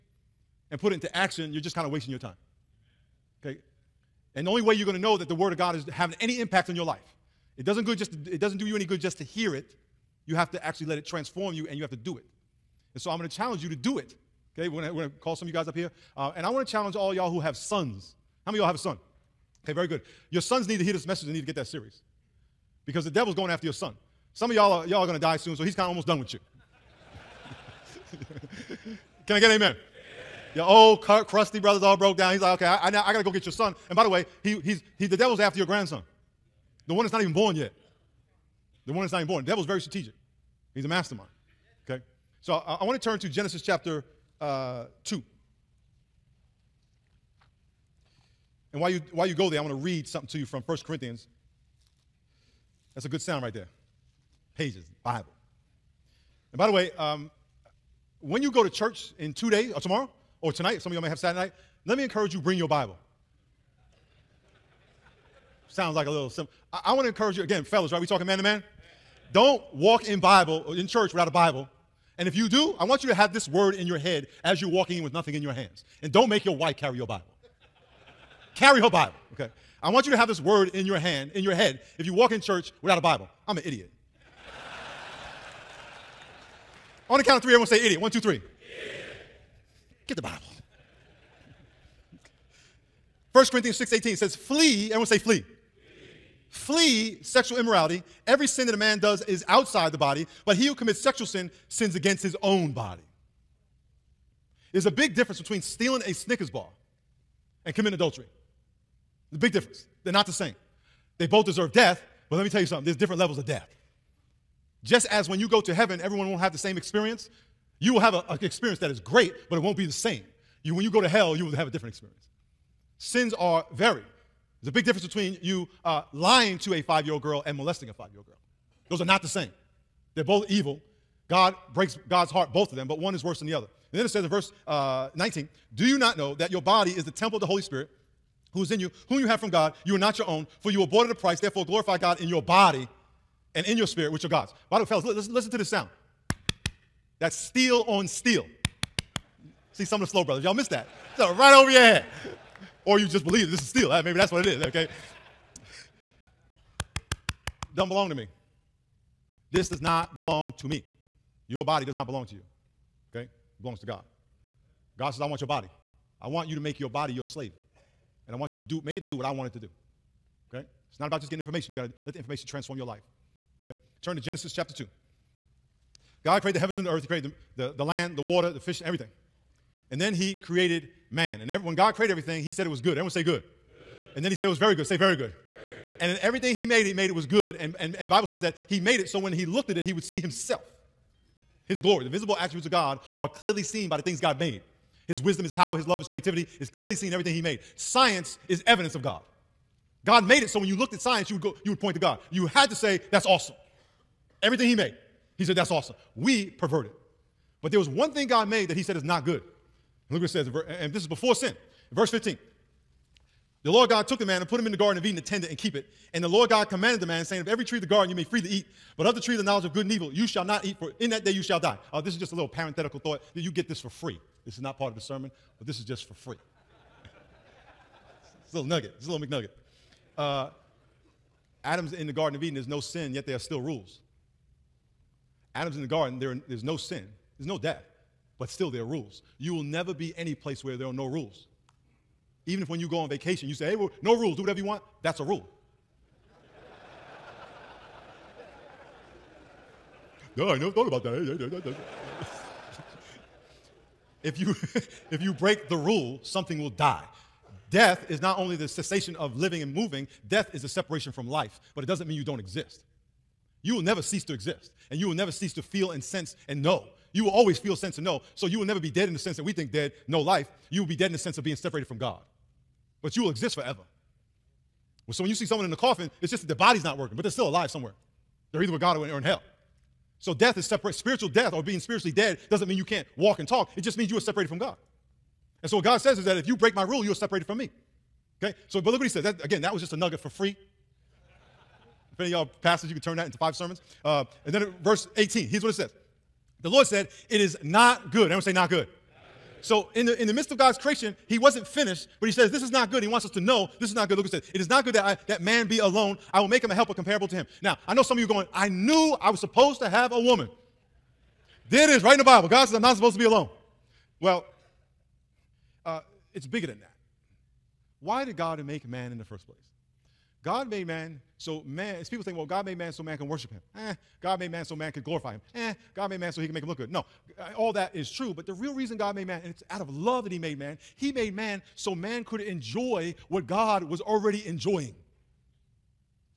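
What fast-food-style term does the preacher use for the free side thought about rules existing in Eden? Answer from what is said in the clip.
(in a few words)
McNugget.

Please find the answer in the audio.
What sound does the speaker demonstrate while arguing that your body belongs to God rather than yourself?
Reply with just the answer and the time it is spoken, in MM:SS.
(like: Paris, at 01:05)
Steel on steel, at 02:27.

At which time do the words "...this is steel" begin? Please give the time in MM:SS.
02:33.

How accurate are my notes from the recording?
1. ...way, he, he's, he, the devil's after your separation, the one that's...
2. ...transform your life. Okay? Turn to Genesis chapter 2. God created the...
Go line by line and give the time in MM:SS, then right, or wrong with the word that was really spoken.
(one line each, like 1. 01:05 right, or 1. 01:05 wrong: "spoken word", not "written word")
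1. 00:34 wrong: "grandson", not "separation"
2. 02:52 right.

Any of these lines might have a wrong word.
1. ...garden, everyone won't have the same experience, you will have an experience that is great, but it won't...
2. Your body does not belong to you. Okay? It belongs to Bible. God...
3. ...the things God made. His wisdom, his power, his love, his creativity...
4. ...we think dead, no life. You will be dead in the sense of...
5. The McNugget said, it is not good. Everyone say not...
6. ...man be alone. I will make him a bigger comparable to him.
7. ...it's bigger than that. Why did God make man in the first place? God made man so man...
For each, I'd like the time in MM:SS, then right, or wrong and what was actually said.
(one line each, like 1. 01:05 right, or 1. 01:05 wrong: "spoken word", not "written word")
1. 01:55 wrong: "heaven", not "garden"
2. 02:41 wrong: "God", not "Bible"
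3. 03:13 right
4. 04:29 right
5. 04:56 wrong: "Lord", not "McNugget"
6. 05:05 wrong: "helper", not "bigger"
7. 05:16 right.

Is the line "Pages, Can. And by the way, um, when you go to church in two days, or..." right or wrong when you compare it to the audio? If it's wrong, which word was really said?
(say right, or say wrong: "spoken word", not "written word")
wrong: "Bible", not "Can".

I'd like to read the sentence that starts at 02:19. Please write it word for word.
You are not your own, for you were bought at a price.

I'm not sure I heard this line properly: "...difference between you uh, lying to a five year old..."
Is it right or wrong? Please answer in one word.
right.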